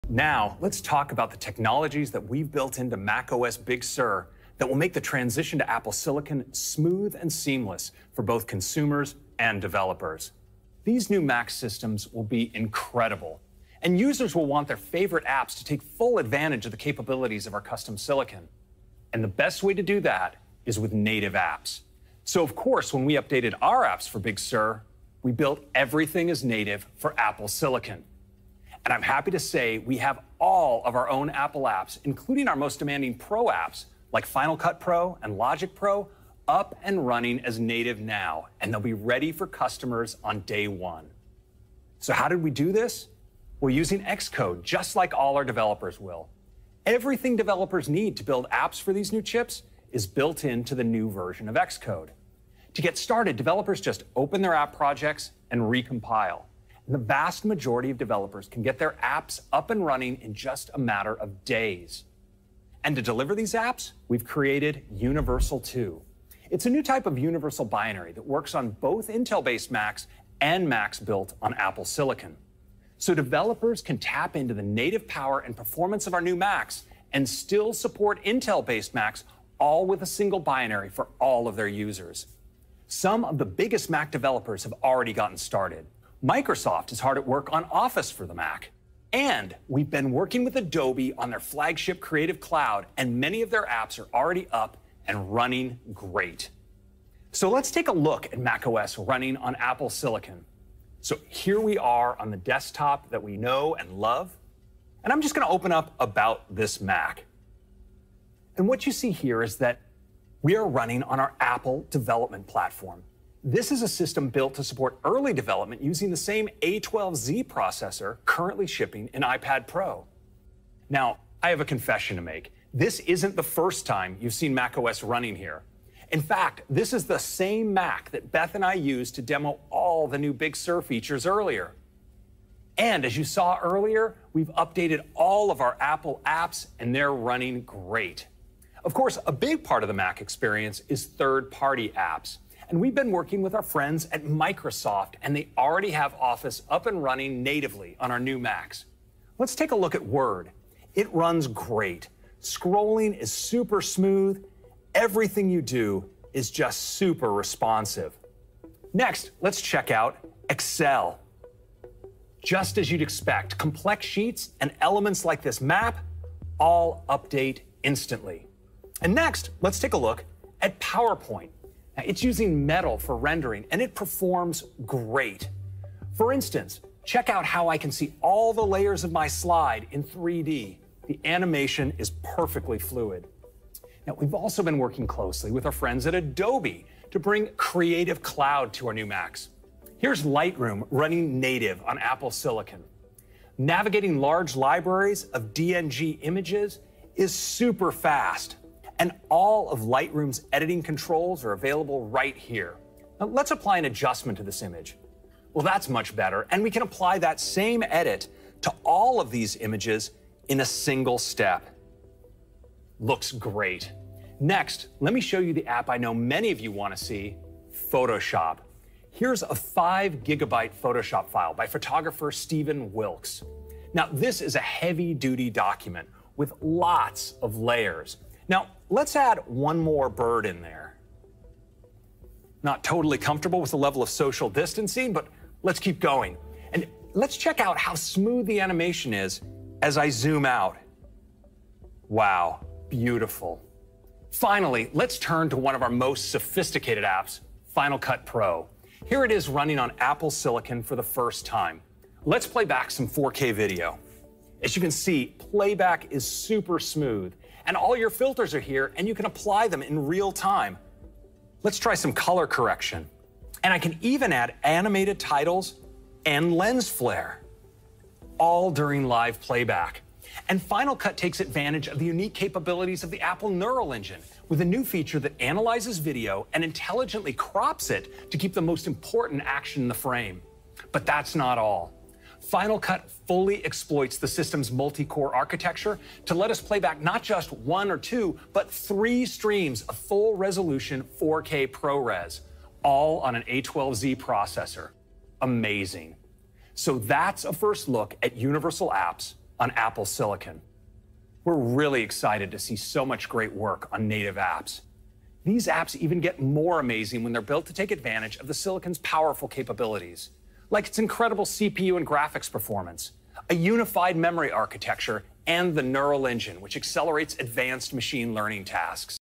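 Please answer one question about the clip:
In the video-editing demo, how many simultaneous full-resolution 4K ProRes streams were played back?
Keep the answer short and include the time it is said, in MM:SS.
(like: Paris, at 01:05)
3, at 04:48.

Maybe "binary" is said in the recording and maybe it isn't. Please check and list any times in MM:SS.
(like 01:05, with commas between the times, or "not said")
01:07, 01:20.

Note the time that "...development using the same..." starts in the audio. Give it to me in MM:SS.
01:55.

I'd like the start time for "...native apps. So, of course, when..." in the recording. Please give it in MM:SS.
00:20.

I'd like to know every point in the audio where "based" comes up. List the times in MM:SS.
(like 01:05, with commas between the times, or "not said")
01:09, 01:18.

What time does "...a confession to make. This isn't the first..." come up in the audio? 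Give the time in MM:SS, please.
02:01.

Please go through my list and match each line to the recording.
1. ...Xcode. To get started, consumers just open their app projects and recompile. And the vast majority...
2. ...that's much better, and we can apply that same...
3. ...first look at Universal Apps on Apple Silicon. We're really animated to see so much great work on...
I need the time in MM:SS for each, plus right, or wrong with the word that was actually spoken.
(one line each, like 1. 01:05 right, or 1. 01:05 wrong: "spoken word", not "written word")
1. 00:51 wrong: "developers", not "consumers"
2. 03:25 right
3. 04:57 wrong: "excited", not "animated".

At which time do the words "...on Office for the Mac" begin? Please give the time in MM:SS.
01:27.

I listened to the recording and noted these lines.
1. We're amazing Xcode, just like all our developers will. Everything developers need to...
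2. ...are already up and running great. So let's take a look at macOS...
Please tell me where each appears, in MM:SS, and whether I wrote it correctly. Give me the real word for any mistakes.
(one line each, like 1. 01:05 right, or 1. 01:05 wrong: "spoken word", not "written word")
1. 00:43 wrong: "using", not "amazing"
2. 01:33 right.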